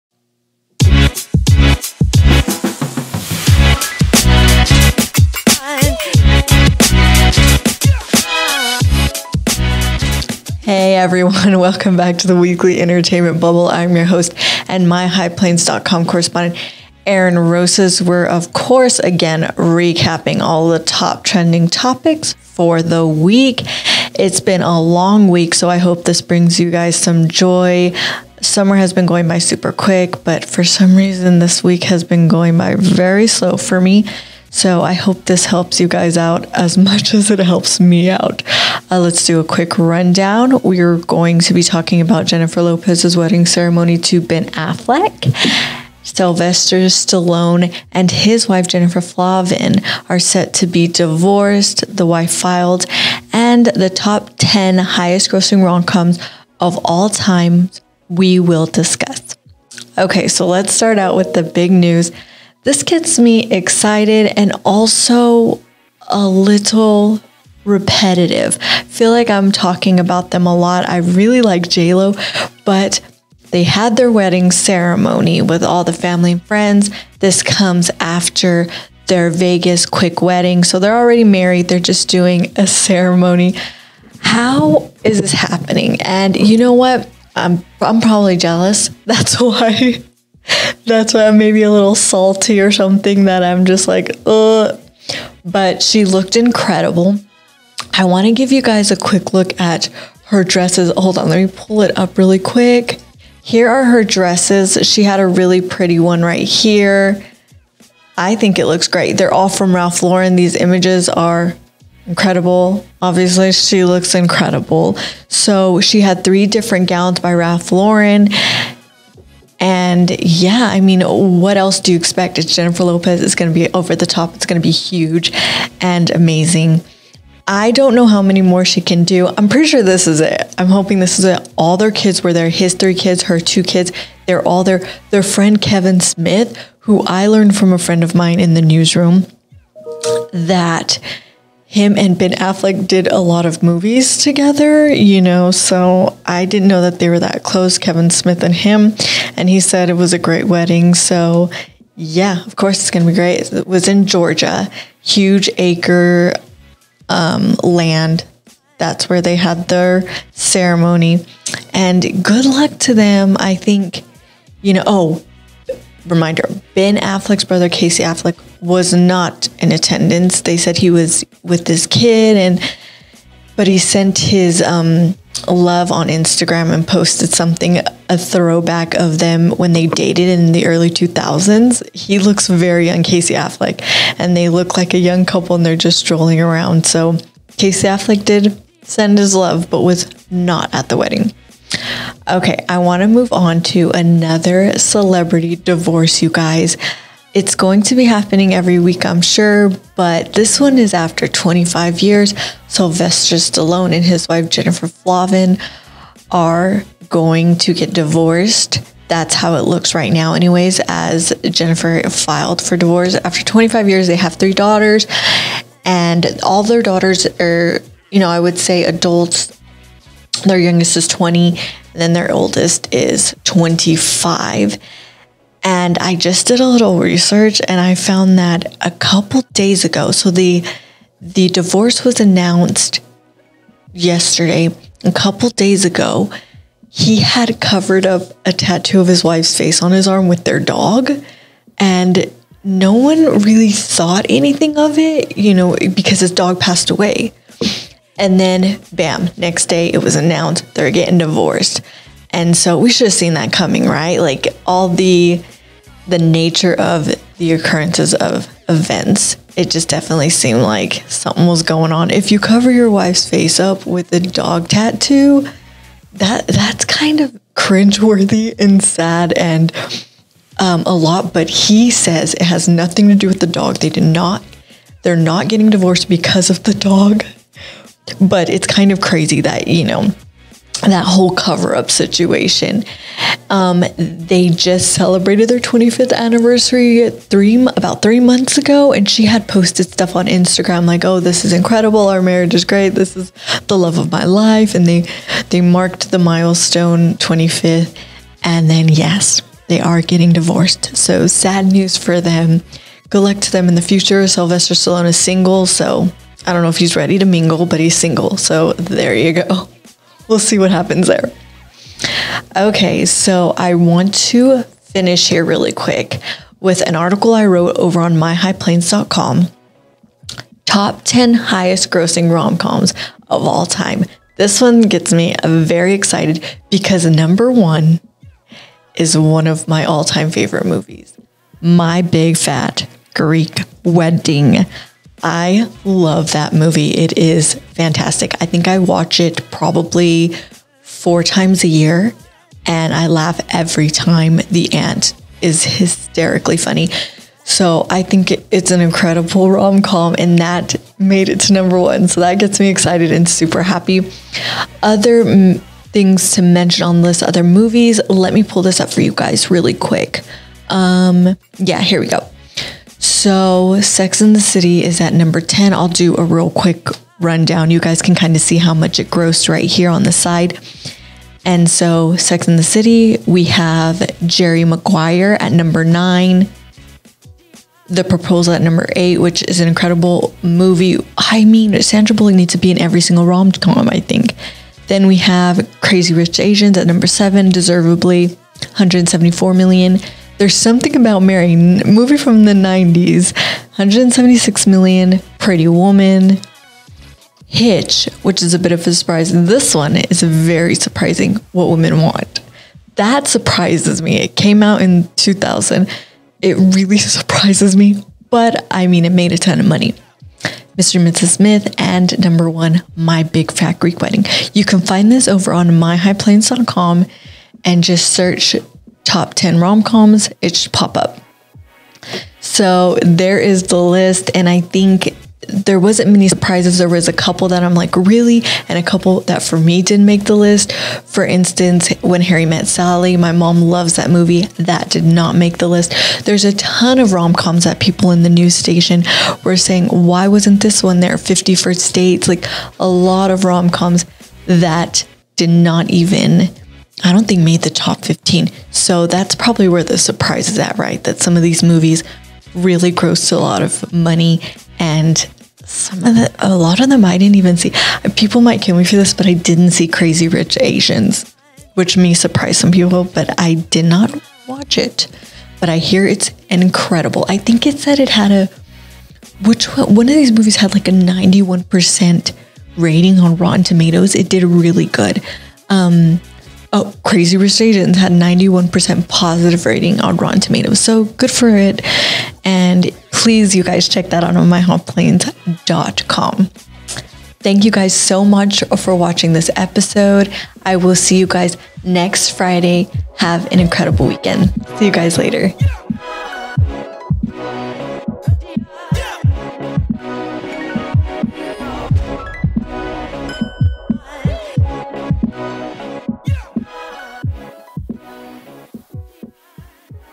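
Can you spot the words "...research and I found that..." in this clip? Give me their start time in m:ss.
3:46.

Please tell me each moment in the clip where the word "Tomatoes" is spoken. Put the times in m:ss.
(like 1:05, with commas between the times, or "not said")
7:53, 8:00.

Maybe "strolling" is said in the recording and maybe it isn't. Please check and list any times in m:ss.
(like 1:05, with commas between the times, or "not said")
3:05.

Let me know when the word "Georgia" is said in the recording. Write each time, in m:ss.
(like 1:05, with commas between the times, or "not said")
2:34.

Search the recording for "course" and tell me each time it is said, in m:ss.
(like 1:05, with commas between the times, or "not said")
0:18, 2:32.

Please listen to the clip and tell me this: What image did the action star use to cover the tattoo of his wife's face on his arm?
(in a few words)
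their dog.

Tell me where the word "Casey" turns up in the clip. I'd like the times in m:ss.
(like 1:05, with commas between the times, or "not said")
2:47, 3:03, 3:07.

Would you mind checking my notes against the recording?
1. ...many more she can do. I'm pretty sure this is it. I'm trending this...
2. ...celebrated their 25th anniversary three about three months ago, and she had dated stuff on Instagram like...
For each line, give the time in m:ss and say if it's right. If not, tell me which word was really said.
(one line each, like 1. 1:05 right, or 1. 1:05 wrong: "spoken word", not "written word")
1. 2:08 wrong: "hoping", not "trending"
2. 4:44 wrong: "posted", not "dated".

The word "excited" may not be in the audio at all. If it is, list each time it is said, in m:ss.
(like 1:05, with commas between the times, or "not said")
1:03, 5:25, 5:52.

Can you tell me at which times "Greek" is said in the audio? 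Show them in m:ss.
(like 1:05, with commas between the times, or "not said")
5:33, 6:53.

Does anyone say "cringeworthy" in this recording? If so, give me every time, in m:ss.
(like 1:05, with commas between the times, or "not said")
4:27.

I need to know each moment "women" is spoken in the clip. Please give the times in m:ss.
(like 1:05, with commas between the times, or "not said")
6:41.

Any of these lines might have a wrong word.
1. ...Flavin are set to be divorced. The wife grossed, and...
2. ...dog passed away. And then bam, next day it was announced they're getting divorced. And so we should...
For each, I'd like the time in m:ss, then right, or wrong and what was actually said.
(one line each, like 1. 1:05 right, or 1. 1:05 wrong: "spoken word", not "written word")
1. 0:48 wrong: "filed", not "grossed"
2. 4:06 right.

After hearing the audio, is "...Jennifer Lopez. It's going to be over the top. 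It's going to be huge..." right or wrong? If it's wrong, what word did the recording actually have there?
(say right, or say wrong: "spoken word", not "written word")
right.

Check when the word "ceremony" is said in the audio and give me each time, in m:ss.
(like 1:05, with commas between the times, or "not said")
0:43, 1:14, 1:22, 2:40.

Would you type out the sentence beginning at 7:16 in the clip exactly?
There's a ton of rom coms that people in the news station were saying, why wasn't this one there?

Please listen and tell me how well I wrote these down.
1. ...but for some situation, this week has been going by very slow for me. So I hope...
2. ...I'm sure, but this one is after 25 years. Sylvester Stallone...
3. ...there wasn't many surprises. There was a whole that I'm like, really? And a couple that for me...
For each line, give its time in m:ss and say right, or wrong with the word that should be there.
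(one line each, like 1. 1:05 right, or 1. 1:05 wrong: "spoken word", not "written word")
1. 0:30 wrong: "reason", not "situation"
2. 3:19 right
3. 7:05 wrong: "couple", not "whole".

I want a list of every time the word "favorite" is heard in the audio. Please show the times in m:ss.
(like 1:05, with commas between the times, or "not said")
5:30.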